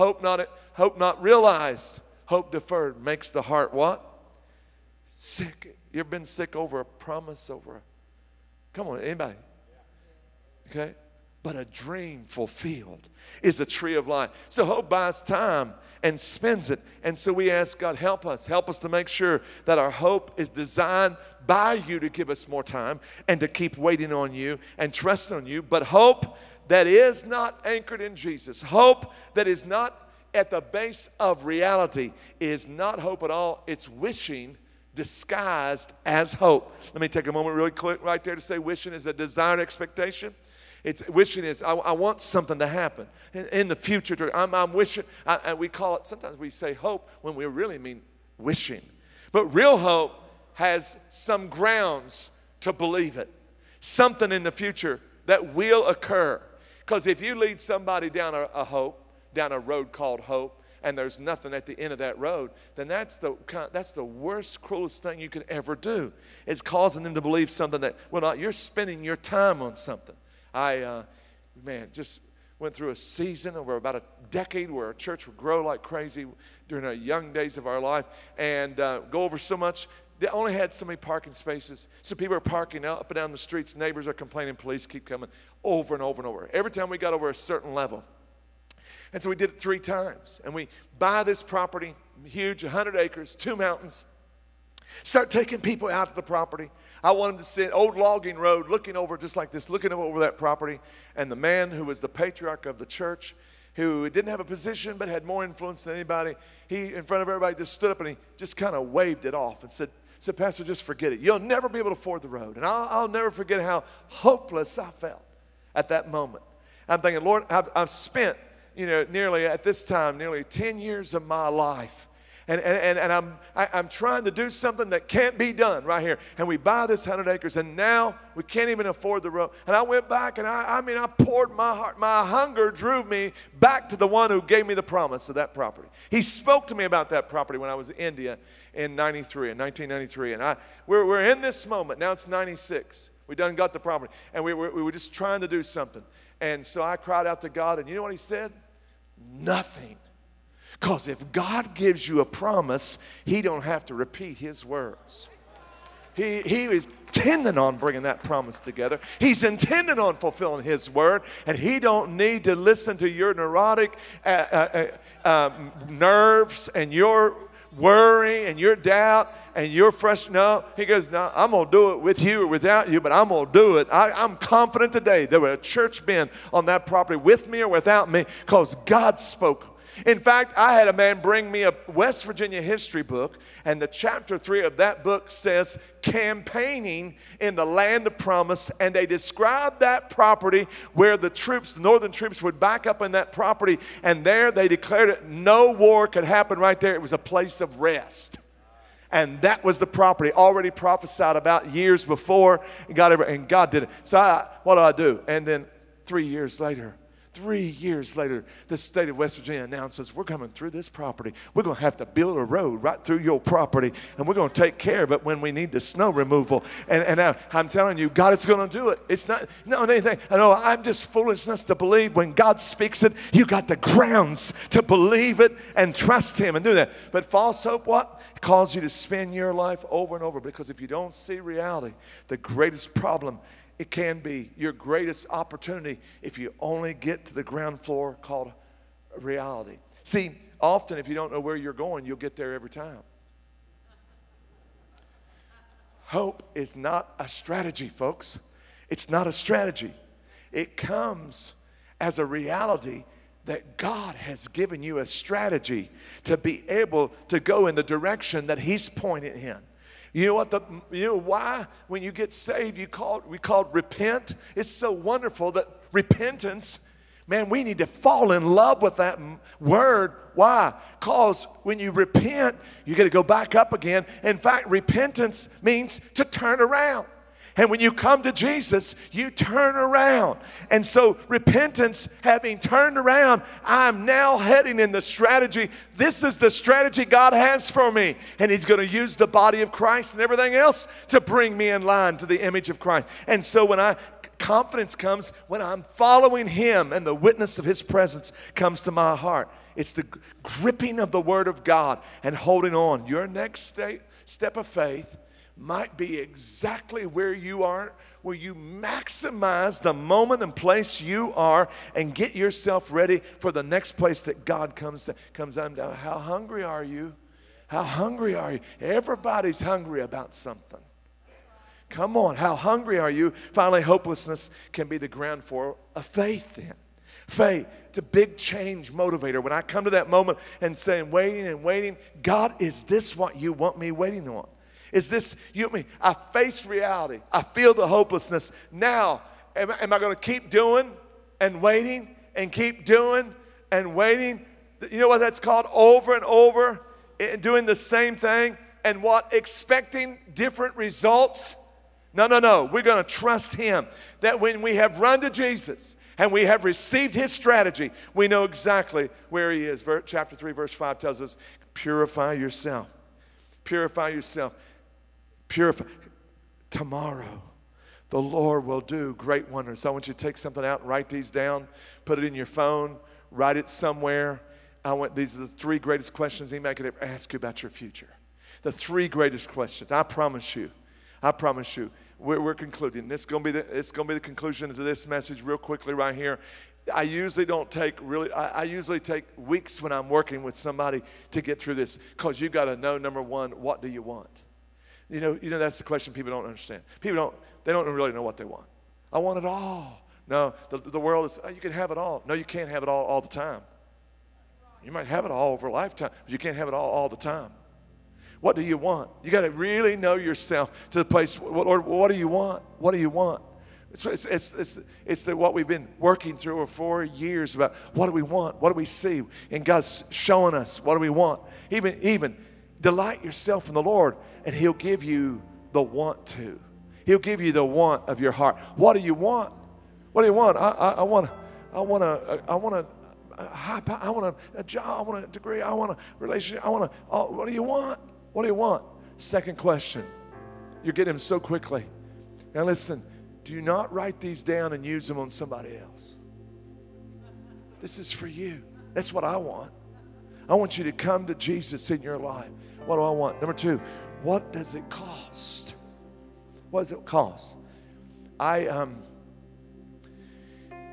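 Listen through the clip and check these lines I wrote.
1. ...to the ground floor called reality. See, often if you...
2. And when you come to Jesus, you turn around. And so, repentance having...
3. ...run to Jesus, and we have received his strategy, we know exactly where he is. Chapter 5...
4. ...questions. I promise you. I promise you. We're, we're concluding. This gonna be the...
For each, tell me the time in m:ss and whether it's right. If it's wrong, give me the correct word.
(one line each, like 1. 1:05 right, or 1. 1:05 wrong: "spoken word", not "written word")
1. 3:57 right
2. 4:37 right
3. 5:54 wrong: "3", not "5"
4. 6:19 right.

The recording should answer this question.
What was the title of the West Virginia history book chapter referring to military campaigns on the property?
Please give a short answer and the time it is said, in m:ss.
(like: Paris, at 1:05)
Campaigning in the land of promise, at 3:06.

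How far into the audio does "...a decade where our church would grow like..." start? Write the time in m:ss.
1:13.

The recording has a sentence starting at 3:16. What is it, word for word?
It was a place of rest.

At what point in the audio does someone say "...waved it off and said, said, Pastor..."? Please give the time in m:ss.
1:48.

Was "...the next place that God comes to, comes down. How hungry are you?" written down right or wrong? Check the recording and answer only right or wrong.
right.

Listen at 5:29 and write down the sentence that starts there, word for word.
When I come to that moment and saying, waiting and waiting, God, is this what you want me waiting on?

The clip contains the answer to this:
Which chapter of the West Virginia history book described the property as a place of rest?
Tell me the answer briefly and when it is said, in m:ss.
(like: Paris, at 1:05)
Chapter 3, at 3:03.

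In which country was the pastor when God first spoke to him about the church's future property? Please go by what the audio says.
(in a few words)
India.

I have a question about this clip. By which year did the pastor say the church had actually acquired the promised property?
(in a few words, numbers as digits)
1996.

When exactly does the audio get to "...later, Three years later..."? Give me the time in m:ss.
3:26.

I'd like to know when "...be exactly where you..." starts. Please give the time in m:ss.
5:05.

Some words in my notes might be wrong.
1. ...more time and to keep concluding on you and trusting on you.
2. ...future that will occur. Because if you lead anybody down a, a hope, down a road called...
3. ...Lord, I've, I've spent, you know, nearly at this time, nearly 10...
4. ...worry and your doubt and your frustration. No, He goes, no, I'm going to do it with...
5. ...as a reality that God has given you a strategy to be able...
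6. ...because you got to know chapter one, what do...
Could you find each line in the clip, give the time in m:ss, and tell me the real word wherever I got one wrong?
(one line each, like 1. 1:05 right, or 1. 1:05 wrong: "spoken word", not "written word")
1. 0:22 wrong: "waiting", not "concluding"
2. 0:54 wrong: "somebody", not "anybody"
3. 1:57 right
4. 2:47 right
5. 4:11 right
6. 6:31 wrong: "number", not "chapter".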